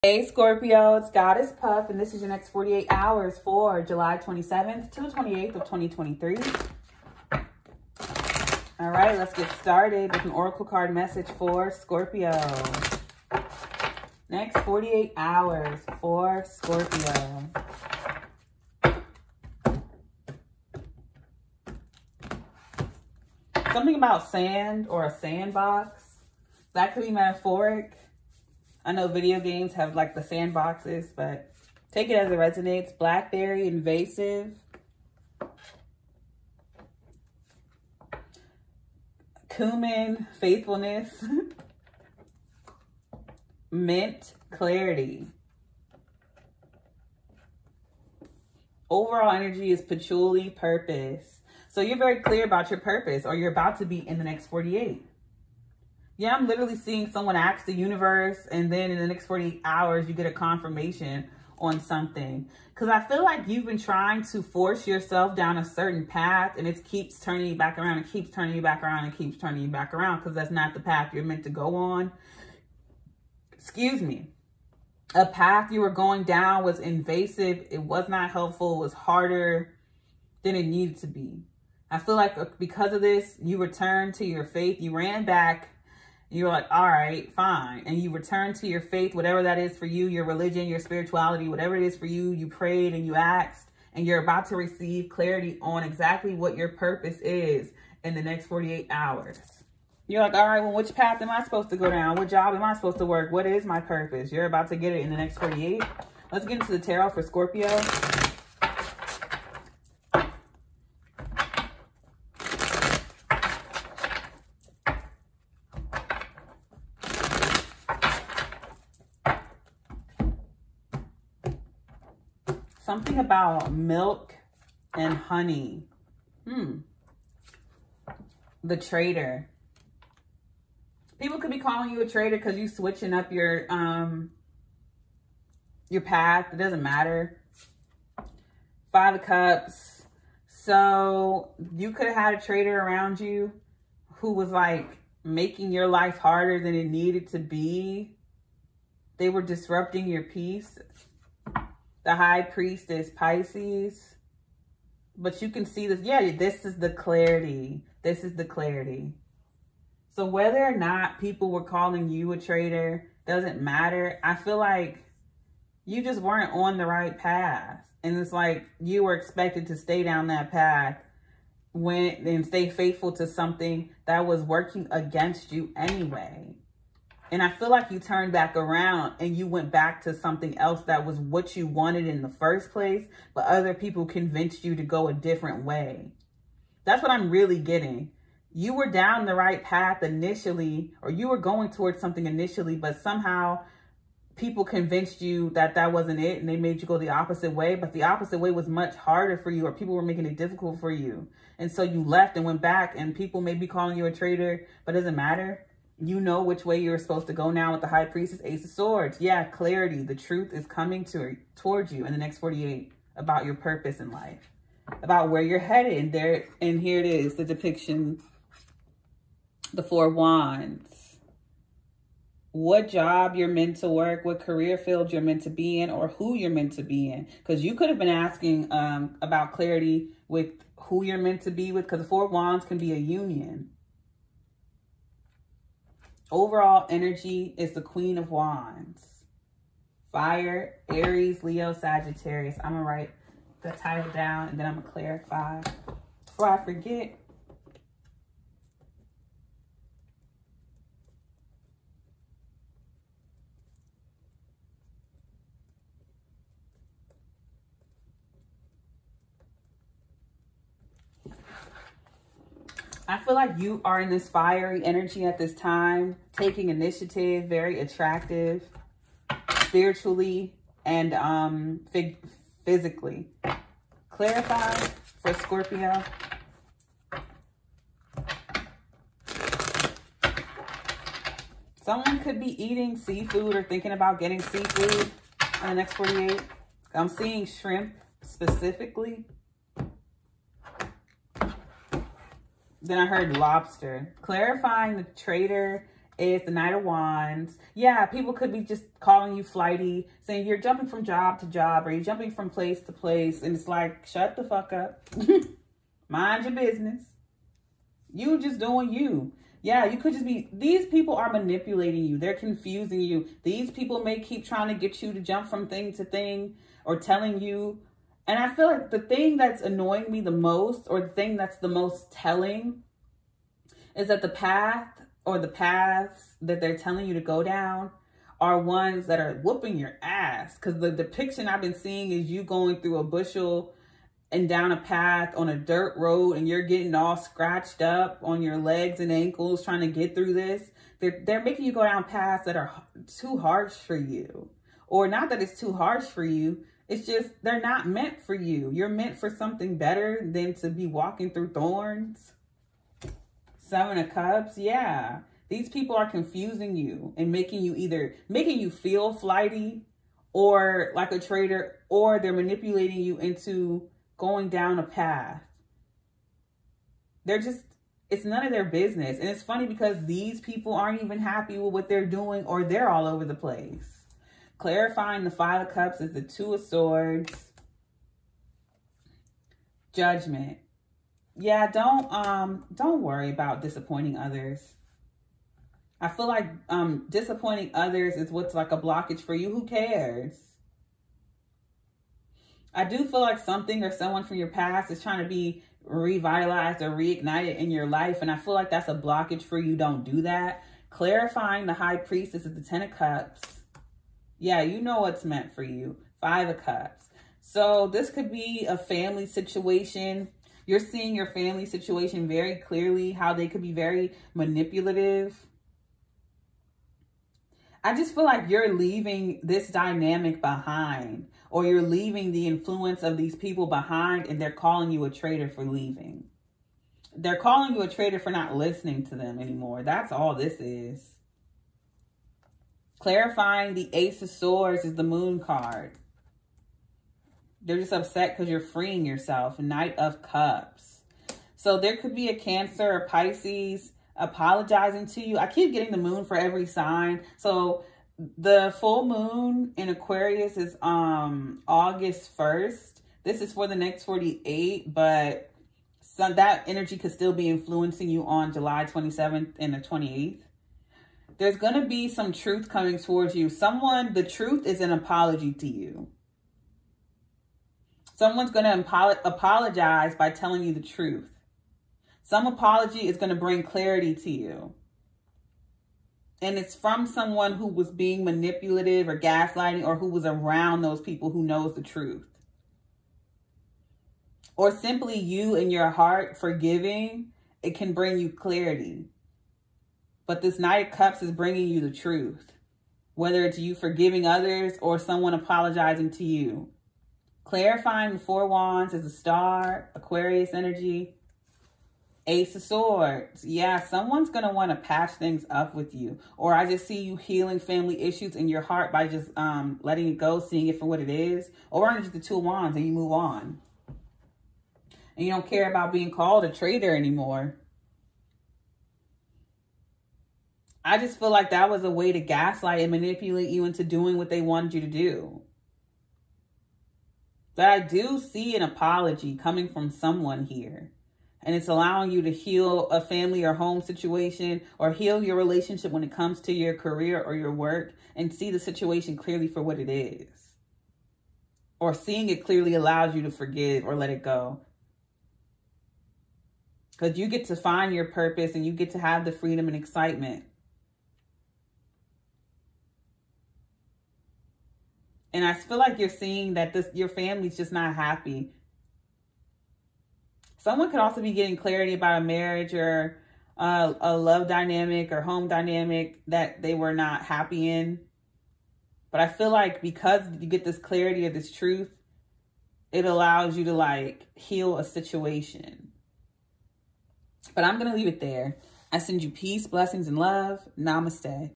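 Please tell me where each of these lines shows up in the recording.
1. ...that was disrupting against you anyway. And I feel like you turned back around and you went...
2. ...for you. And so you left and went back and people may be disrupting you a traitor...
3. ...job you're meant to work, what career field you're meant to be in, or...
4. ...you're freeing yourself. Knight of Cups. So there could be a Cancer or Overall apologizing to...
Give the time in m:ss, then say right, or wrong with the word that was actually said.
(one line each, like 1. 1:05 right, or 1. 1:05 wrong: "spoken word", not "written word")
1. 2:54 wrong: "working", not "disrupting"
2. 3:20 wrong: "calling", not "disrupting"
3. 3:42 right
4. 7:18 wrong: "Pisces", not "Overall".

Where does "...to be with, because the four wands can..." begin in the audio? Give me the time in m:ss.
3:51.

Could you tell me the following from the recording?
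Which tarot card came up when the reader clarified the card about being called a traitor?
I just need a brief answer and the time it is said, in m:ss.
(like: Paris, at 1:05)
Knight of Wands, at 4:56.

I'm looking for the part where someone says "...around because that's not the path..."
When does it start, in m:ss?
1:09.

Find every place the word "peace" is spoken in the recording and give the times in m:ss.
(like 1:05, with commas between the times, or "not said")
2:30, 9:39.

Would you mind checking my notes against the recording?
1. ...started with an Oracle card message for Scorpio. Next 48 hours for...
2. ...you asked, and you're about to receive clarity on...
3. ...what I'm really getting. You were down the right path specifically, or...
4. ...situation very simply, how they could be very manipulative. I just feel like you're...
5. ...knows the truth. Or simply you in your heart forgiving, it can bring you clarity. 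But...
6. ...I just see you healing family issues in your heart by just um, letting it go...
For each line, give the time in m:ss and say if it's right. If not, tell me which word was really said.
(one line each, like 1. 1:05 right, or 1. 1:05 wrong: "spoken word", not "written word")
1. 0:09 right
2. 1:33 right
3. 3:07 wrong: "initially", not "specifically"
4. 6:51 wrong: "clearly", not "simply"
5. 8:01 right
6. 8:26 right.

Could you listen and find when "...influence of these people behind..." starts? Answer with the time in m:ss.
7:02.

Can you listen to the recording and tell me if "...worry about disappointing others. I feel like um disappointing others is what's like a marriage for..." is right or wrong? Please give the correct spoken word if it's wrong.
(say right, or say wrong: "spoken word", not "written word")
wrong: "blockage", not "marriage".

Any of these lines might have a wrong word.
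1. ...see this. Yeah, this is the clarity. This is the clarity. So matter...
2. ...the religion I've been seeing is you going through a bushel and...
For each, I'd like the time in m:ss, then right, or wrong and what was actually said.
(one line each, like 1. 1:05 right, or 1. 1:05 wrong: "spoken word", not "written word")
1. 2:35 wrong: "whether", not "matter"
2. 5:30 wrong: "depiction", not "religion".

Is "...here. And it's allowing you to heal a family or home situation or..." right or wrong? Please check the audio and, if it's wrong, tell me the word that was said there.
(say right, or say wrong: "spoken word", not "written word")
right.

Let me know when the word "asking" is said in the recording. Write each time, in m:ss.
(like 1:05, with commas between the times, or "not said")
3:48.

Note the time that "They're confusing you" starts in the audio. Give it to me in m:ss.
5:12.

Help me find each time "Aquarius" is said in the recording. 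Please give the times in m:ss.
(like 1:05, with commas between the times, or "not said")
7:29, 8:19.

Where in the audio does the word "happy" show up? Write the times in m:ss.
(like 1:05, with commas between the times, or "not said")
6:11, 9:17, 9:27.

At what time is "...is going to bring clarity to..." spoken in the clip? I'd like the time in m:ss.
7:53.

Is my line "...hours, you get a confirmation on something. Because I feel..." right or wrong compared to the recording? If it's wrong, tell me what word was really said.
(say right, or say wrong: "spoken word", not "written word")
right.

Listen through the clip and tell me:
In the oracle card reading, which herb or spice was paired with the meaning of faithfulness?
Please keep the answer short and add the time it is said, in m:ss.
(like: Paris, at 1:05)
Cumin, at 0:39.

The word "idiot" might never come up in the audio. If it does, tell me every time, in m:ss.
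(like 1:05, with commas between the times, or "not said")
not said.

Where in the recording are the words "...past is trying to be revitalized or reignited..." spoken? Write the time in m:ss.
6:34.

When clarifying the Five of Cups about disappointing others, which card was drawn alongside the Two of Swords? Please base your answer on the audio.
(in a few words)
Judgment.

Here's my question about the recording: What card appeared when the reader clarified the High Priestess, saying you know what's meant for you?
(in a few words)
Ten of Cups.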